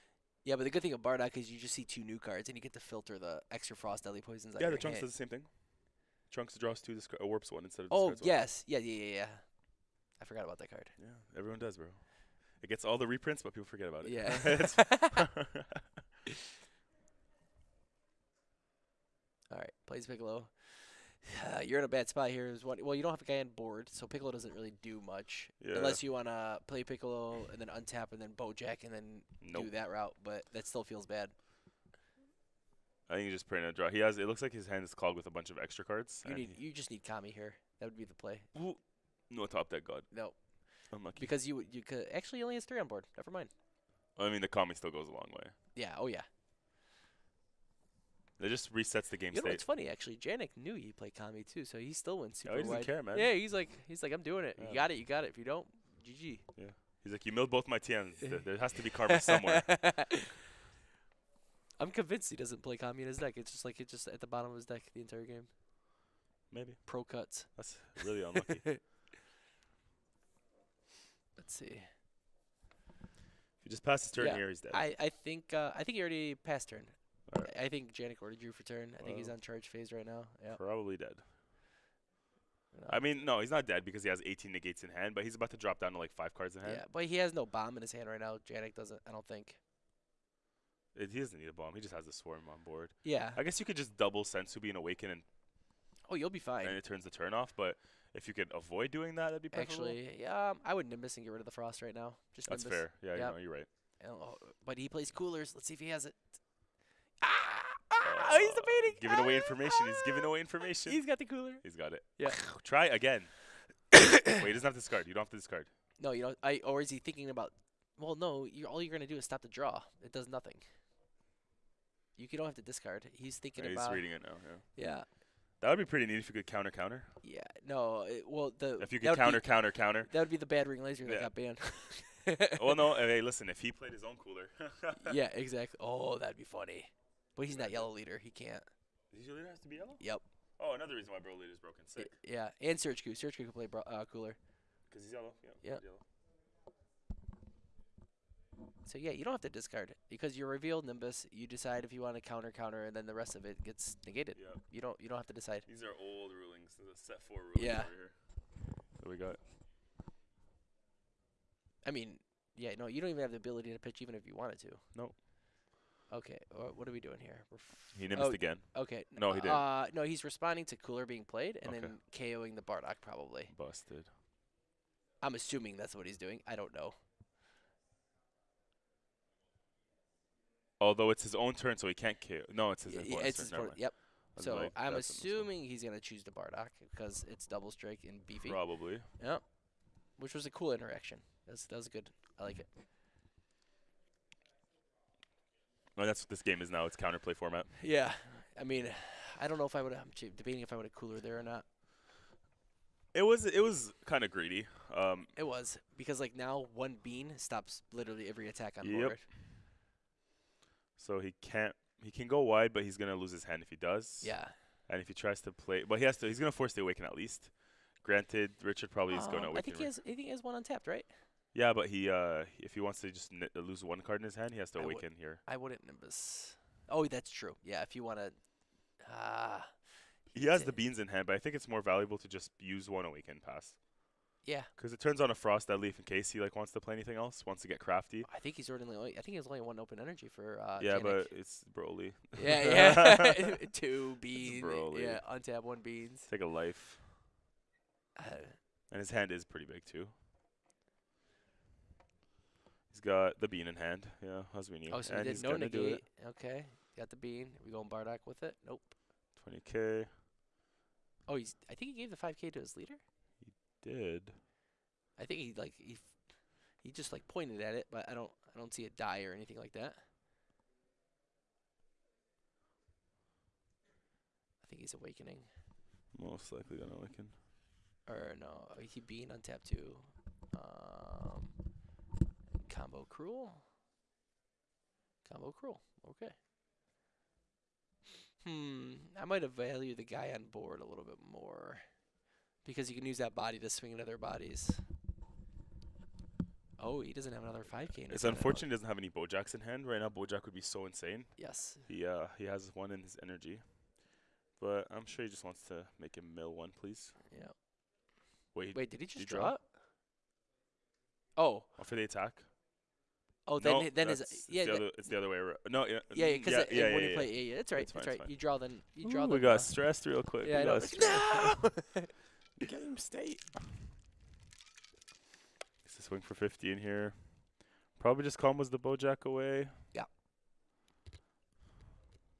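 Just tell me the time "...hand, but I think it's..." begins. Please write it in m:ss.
3:51.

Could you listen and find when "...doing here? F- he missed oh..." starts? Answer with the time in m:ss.
2:46.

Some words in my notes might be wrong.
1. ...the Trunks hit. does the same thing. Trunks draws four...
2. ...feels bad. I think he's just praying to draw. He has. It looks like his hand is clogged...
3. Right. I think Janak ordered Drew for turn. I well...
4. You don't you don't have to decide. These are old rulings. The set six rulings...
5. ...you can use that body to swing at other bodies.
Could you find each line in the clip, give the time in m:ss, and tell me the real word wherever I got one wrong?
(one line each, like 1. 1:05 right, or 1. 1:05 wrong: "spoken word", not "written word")
1. 0:04 wrong: "two", not "four"
2. 0:30 right
3. 1:17 right
4. 2:34 wrong: "four", not "six"
5. 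4:52 right.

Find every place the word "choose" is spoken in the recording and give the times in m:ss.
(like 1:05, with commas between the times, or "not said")
3:05.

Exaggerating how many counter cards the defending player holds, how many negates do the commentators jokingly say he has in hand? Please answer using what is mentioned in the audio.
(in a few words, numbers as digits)
18.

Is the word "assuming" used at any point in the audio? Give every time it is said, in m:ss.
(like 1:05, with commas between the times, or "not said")
2:55, 3:04.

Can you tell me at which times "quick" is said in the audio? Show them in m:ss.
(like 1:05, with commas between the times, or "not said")
5:20.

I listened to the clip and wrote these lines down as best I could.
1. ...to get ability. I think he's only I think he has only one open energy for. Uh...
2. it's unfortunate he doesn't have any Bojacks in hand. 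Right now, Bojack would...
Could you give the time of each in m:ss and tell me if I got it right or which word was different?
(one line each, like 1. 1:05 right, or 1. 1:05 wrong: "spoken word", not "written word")
1. 3:57 wrong: "crafty", not "ability"
2. 4:58 right.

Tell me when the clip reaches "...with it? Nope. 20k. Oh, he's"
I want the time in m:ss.
4:18.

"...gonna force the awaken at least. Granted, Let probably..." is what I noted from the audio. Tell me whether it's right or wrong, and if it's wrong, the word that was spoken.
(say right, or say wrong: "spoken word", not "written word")
wrong: "Richard", not "Let".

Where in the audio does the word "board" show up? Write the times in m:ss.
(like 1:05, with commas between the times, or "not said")
0:23, 0:42, 1:32, 3:28, 4:50.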